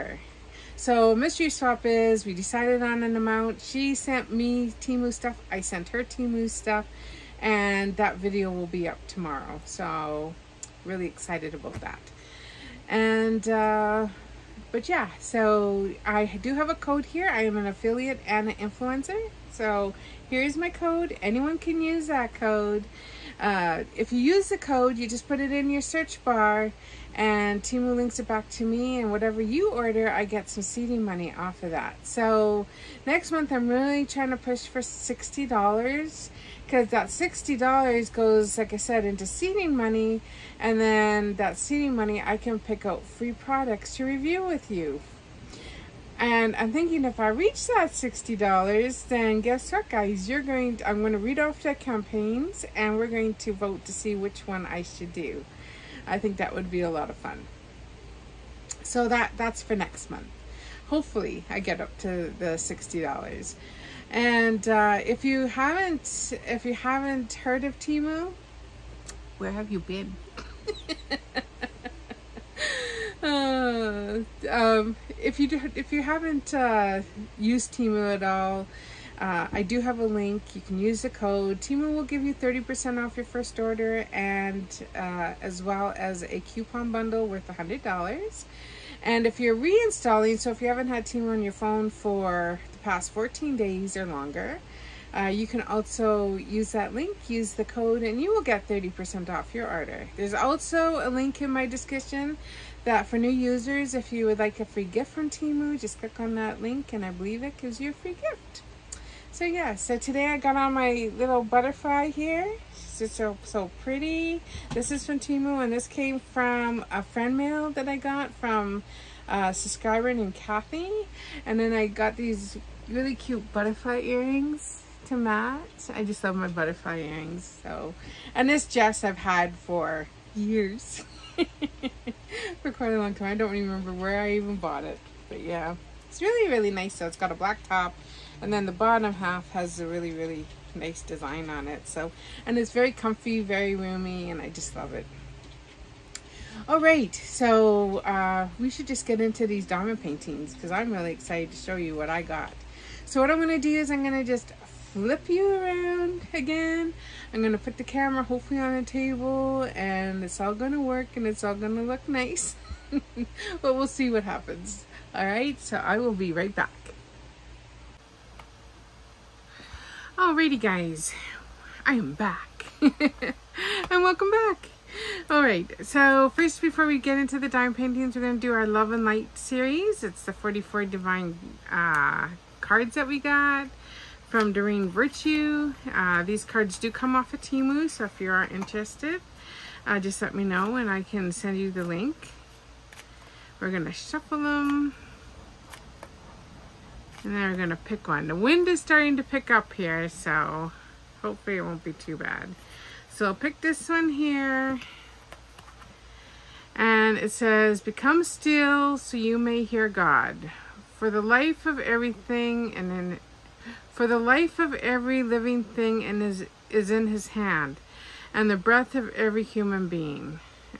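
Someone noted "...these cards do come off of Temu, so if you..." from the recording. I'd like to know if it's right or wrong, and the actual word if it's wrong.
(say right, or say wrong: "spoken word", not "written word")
right.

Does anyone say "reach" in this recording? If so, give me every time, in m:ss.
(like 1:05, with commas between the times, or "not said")
0:47.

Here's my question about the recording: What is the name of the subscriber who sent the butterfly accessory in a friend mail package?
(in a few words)
Kathy.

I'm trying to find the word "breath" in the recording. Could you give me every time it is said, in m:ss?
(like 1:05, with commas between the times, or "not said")
3:38.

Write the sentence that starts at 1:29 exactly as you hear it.
And if you're reinstalling, so if you haven't had Temu on your phone for past 14 days or longer.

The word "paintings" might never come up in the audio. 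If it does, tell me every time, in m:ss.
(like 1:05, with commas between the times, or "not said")
2:30, 2:57.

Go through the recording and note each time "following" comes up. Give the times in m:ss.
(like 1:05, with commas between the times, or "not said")
not said.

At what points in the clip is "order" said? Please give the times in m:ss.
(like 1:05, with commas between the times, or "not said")
0:29, 1:23, 1:39.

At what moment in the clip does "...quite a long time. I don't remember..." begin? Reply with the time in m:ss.
2:12.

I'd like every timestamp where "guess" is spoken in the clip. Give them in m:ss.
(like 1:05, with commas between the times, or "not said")
0:49.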